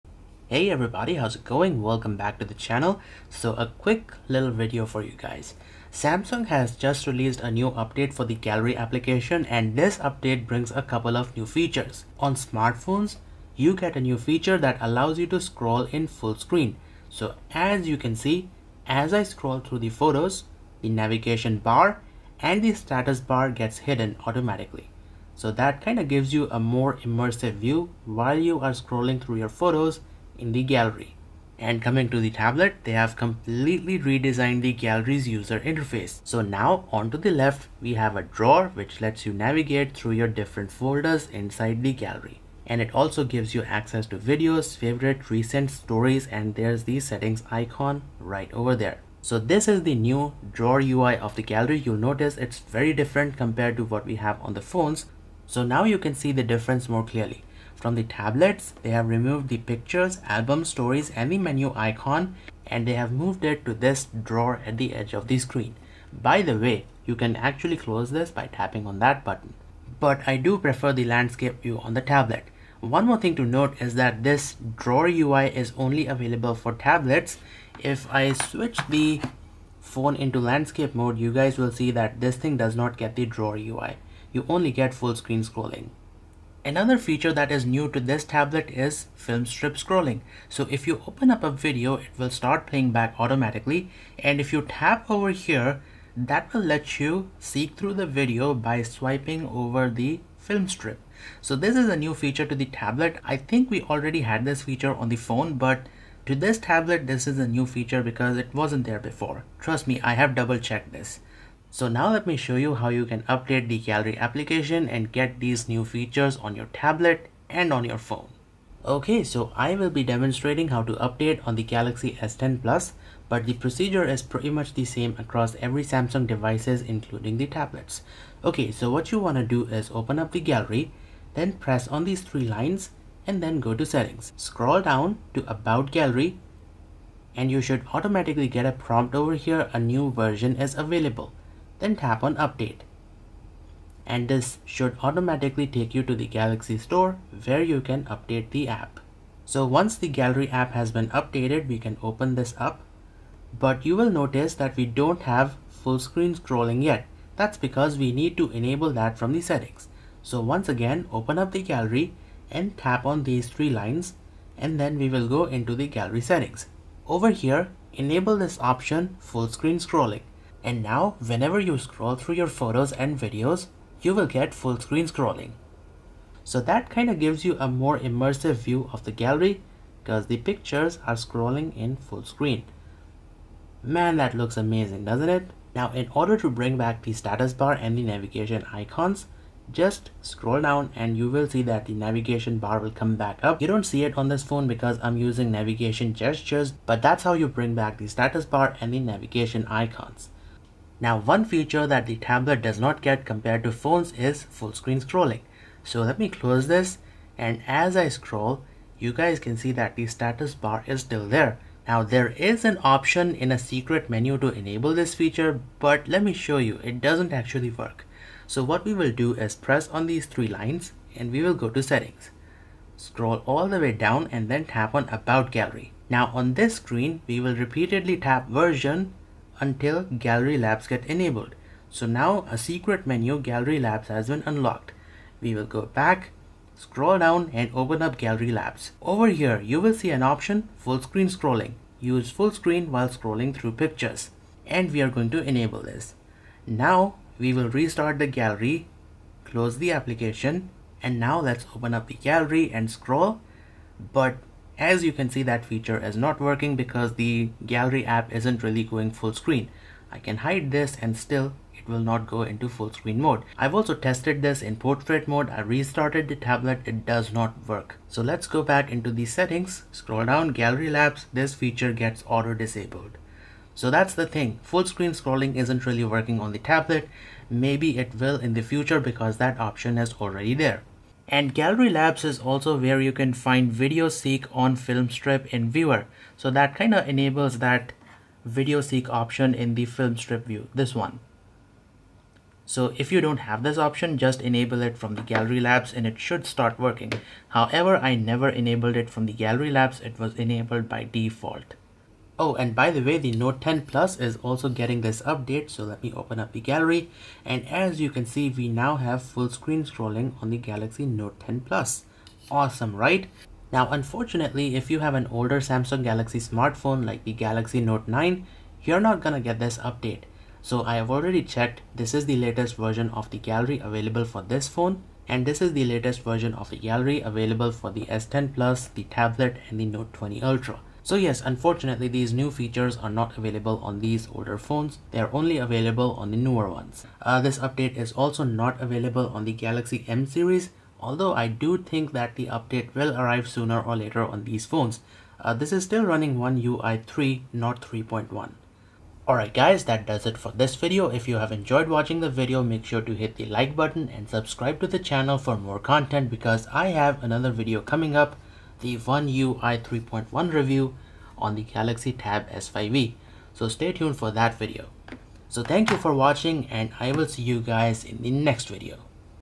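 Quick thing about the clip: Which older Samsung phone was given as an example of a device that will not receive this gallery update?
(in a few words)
Galaxy Note 9.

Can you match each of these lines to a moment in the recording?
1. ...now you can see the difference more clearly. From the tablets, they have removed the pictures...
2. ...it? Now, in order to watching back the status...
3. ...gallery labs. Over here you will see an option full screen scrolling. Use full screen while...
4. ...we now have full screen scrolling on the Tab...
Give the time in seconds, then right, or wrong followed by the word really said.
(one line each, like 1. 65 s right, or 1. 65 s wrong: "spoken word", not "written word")
1. 55 s right
2. 185 s wrong: "bring", not "watching"
3. 238 s right
4. 308 s wrong: "Galaxy", not "Tab".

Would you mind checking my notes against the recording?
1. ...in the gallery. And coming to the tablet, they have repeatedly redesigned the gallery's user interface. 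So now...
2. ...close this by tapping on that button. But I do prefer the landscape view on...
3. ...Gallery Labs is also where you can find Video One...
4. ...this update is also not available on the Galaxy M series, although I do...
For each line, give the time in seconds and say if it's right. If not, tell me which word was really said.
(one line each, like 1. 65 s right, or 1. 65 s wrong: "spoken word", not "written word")
1. 30 s wrong: "completely", not "repeatedly"
2. 67 s right
3. 281 s wrong: "Seek", not "One"
4. 337 s right.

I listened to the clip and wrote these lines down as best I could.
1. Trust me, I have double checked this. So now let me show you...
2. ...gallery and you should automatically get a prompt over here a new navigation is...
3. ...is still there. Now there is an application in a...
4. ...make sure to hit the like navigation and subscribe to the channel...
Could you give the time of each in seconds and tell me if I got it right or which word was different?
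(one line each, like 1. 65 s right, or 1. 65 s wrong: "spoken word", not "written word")
1. 109 s right
2. 135 s wrong: "version", not "navigation"
3. 210 s wrong: "option", not "application"
4. 352 s wrong: "button", not "navigation".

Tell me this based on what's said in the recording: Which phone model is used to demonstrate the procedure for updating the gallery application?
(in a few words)
Galaxy S10 Plus.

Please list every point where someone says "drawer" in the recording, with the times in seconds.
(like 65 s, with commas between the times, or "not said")
38 s, 50 s, 64 s, 74 s, 83 s.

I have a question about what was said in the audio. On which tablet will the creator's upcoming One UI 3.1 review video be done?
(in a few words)
Galaxy Tab S5e.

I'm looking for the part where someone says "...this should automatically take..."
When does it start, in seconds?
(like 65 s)
144 s.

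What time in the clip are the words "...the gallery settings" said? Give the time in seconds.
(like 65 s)
165 s.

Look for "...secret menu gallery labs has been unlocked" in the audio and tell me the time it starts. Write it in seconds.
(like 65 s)
232 s.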